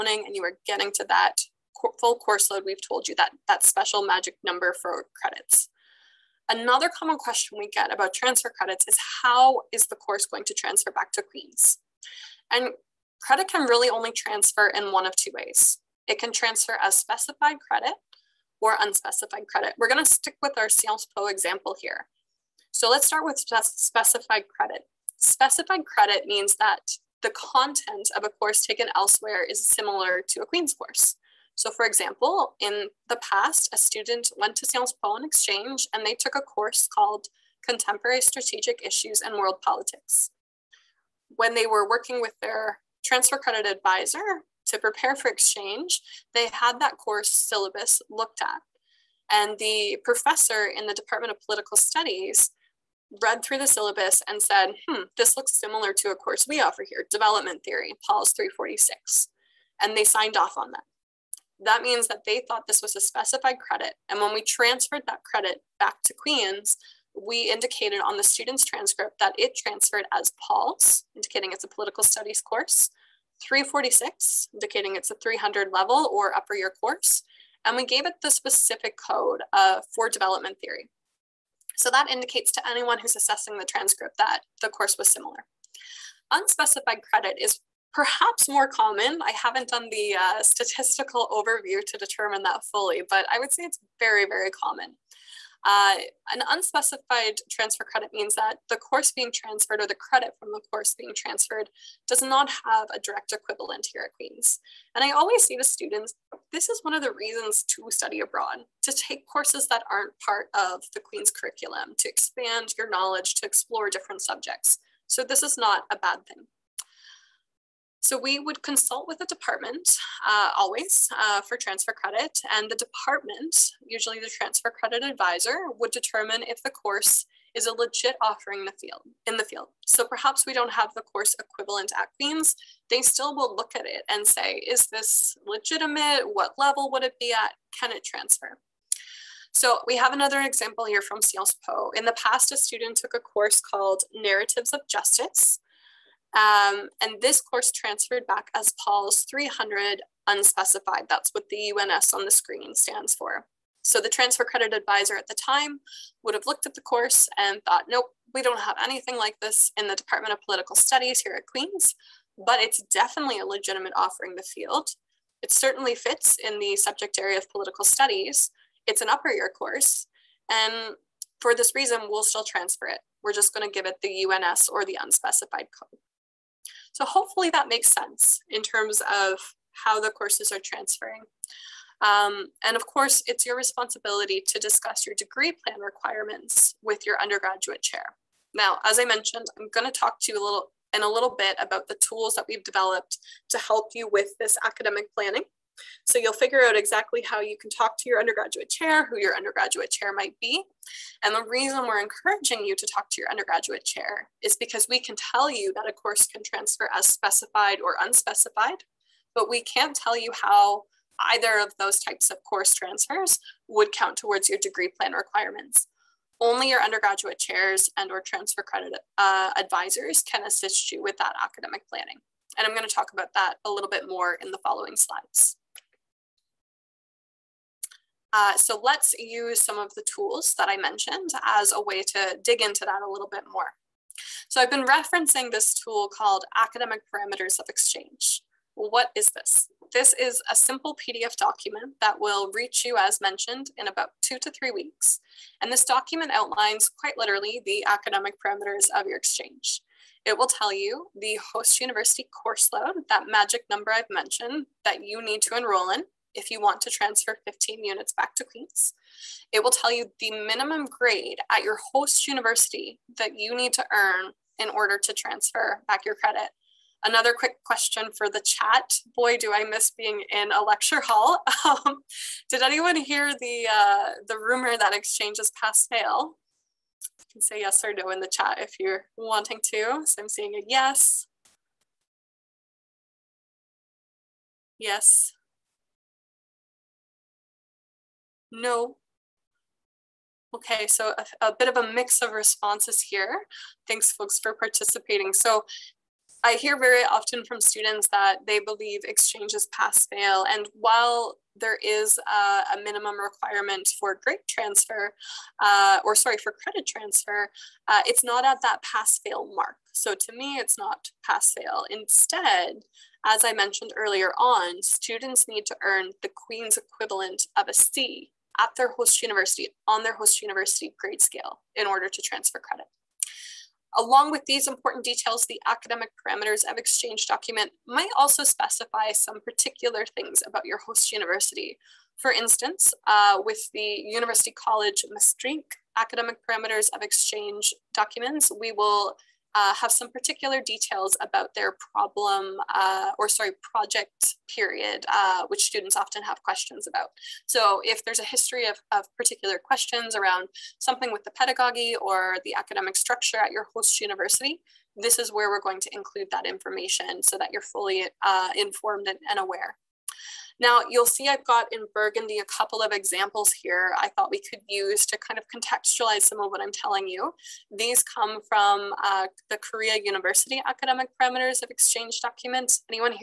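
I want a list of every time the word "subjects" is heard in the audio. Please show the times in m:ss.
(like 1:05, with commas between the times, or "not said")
1:54, 2:46.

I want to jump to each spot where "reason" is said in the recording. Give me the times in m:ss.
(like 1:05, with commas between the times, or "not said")
1:47, 2:51, 3:21.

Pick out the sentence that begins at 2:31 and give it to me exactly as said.
That's what the UNS on the screen stands for.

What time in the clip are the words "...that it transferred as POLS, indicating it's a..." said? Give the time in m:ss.
1:09.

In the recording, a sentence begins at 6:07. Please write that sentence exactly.
These come from uh, the Korea University Academic Parameters of Exchange Documents.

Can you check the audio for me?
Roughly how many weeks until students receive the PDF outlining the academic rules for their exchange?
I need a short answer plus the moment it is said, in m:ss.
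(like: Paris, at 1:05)
2 to 3 weeks, at 4:04.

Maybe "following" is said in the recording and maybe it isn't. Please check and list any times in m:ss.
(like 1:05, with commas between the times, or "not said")
3:44.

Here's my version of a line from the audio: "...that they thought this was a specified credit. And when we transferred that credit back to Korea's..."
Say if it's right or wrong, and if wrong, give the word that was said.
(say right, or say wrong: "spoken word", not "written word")
wrong: "Queen", not "Korea".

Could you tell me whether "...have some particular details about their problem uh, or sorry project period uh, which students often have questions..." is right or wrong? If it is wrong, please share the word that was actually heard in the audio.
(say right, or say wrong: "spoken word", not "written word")
right.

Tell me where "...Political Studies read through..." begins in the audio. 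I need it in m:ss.
0:51.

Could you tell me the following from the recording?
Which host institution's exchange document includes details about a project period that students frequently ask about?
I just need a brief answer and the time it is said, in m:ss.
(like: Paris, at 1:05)
University College Maastricht, at 5:34.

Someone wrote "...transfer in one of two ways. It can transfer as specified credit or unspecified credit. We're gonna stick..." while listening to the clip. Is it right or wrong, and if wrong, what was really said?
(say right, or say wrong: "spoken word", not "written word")
right.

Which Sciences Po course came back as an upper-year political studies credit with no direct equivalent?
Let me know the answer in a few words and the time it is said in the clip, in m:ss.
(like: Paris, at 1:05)
Narratives of Justice, at 2:24.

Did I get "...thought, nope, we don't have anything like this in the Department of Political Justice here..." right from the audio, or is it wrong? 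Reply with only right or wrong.
wrong.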